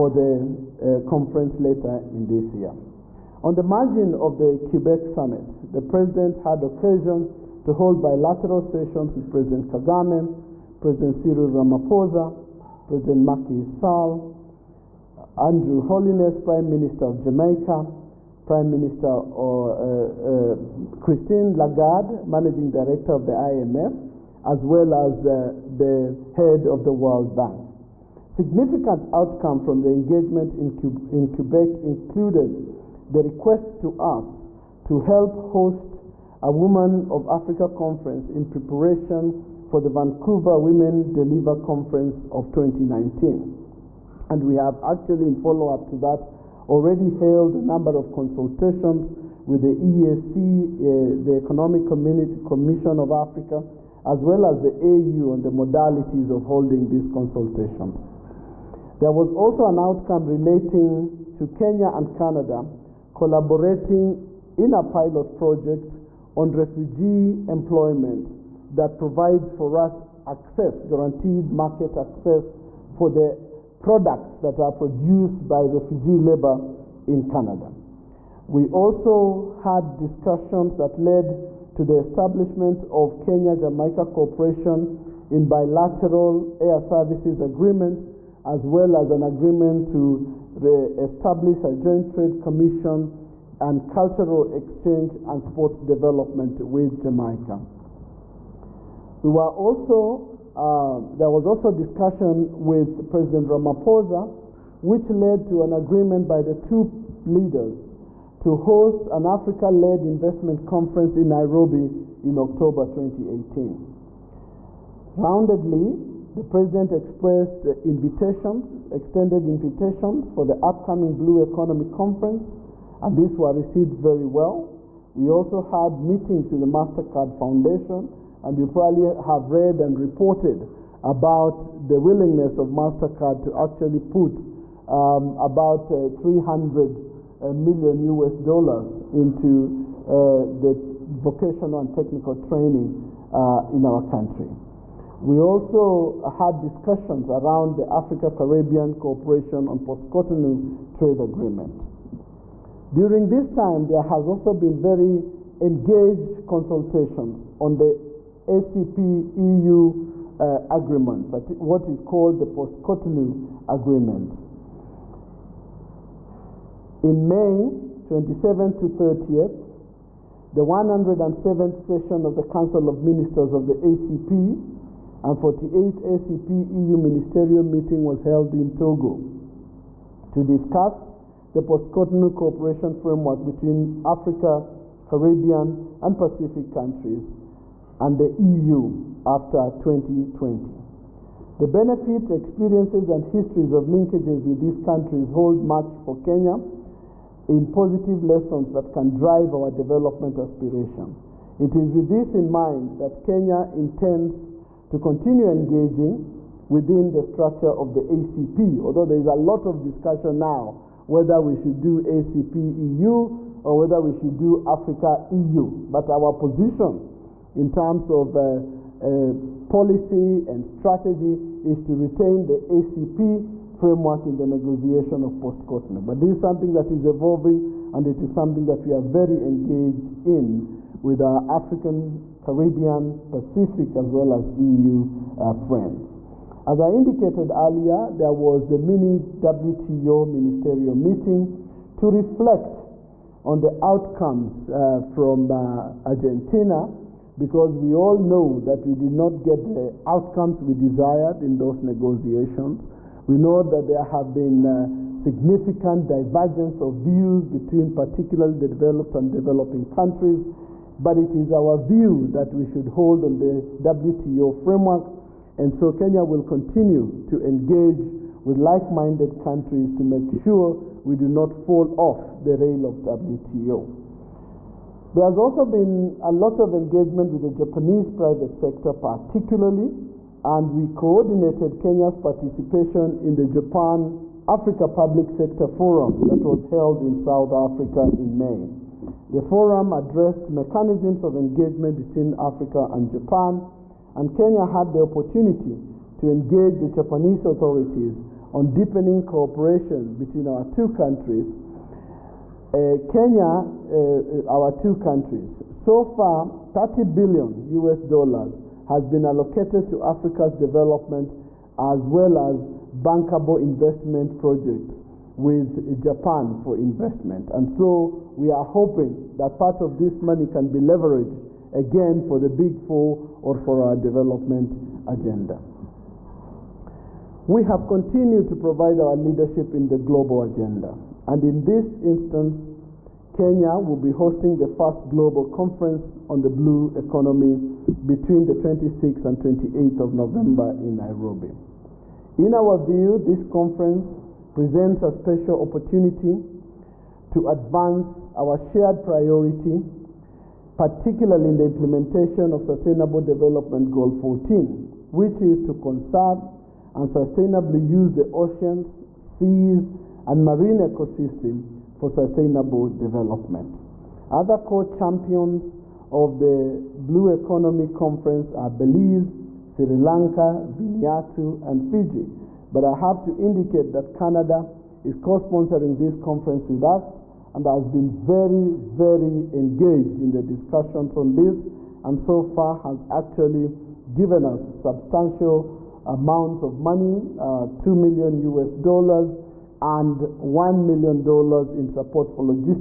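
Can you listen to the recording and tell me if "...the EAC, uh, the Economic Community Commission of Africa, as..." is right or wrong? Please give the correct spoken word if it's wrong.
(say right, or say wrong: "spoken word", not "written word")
right.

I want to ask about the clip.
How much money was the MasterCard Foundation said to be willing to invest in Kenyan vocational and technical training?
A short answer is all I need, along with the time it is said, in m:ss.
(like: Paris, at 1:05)
$300 million, at 2:16.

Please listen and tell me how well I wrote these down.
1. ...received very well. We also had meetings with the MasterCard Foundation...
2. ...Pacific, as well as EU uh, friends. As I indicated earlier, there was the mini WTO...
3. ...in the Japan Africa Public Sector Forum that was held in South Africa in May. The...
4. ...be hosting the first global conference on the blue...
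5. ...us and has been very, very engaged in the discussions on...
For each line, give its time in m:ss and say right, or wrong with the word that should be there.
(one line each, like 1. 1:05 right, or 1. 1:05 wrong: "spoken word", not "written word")
1. 2:03 right
2. 3:53 right
3. 4:43 right
4. 5:33 right
5. 6:16 right.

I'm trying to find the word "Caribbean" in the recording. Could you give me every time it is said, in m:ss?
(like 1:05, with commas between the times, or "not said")
2:27, 3:05, 3:52.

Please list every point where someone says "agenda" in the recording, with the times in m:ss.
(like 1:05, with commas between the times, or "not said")
5:25, 5:30.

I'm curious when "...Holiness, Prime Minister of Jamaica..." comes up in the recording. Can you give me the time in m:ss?
0:15.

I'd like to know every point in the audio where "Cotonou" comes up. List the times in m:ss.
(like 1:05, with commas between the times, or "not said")
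2:29, 2:42, 3:01, 3:45.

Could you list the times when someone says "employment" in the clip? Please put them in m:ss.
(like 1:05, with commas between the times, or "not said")
1:07.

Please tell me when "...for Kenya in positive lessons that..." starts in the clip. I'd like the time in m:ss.
3:15.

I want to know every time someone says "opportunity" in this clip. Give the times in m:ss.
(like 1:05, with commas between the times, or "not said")
4:55, 5:45.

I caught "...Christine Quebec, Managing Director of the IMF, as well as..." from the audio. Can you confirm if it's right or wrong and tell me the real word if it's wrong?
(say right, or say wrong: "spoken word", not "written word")
wrong: "Lagarde", not "Quebec".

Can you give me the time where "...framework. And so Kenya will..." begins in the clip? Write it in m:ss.
4:24.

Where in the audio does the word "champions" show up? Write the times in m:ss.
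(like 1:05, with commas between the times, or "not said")
6:04.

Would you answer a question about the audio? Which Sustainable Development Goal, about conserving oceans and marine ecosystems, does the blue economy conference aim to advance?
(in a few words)
Goal 14.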